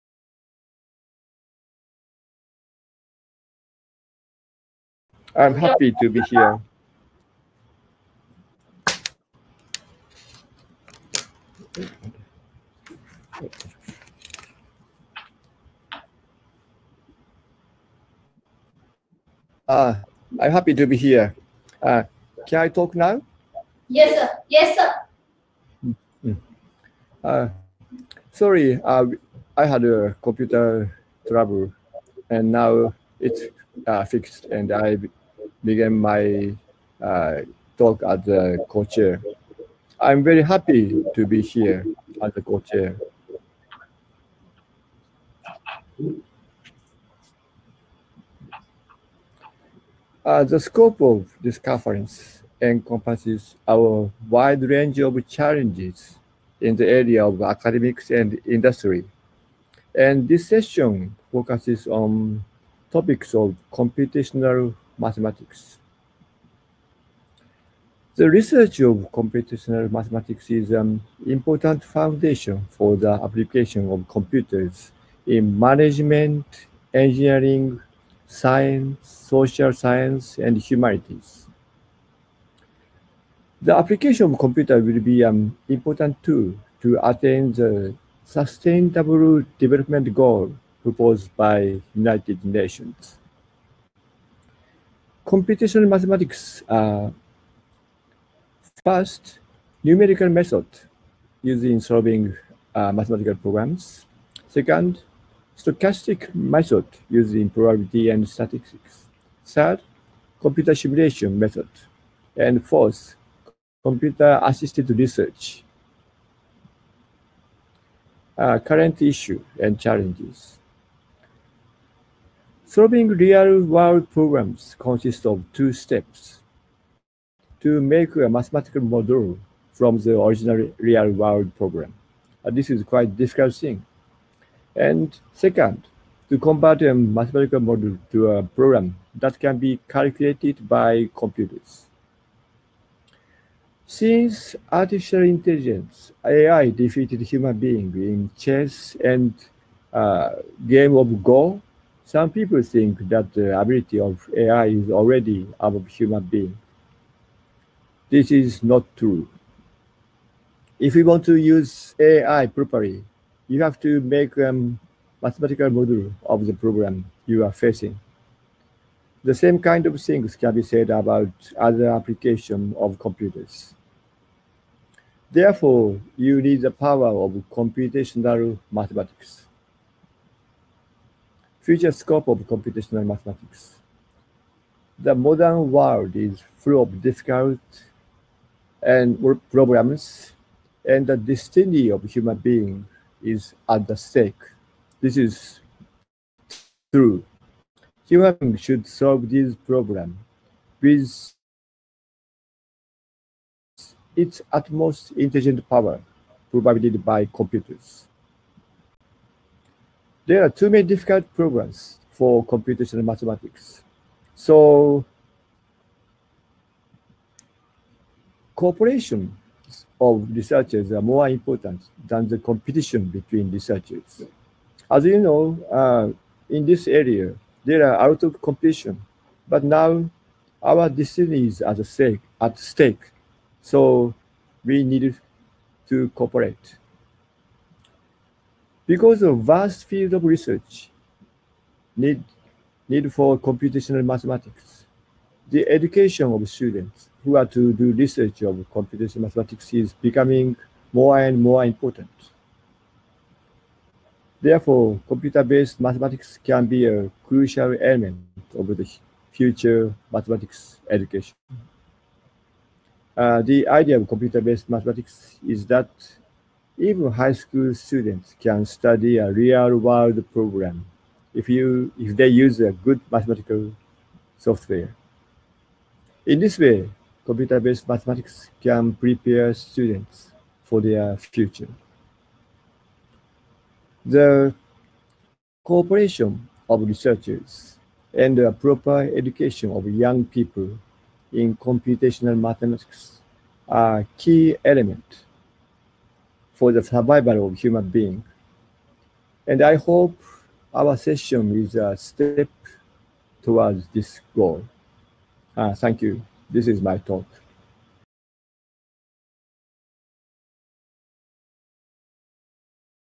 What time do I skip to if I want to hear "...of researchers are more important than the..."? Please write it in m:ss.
3:39.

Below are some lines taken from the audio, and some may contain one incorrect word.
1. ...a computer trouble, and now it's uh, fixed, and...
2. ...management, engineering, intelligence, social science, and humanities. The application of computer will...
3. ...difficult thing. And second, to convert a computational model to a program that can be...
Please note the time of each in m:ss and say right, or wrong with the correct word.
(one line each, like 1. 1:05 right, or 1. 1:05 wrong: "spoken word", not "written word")
1. 0:29 right
2. 1:15 wrong: "science", not "intelligence"
3. 2:13 wrong: "mathematical", not "computational".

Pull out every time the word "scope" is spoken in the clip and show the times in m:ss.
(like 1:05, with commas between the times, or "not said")
0:50, 3:01.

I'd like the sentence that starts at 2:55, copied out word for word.
Therefore, you need the power of computational mathematics.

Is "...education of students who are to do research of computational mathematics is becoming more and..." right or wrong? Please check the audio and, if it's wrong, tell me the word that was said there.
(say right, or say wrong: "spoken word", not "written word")
right.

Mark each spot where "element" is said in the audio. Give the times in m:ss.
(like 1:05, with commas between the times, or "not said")
4:17, 4:54.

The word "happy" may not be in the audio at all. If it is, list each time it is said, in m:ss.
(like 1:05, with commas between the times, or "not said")
0:05, 0:20, 0:40.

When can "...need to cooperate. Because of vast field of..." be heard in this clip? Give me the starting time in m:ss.
3:54.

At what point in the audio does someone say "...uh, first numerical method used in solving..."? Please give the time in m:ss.
1:37.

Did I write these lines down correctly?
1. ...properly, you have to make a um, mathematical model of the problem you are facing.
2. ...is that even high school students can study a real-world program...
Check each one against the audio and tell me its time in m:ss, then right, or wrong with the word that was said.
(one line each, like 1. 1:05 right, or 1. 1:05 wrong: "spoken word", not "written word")
1. 2:42 right
2. 4:25 right.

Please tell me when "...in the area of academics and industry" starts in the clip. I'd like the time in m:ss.
0:56.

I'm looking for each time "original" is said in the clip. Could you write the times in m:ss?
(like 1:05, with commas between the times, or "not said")
2:10.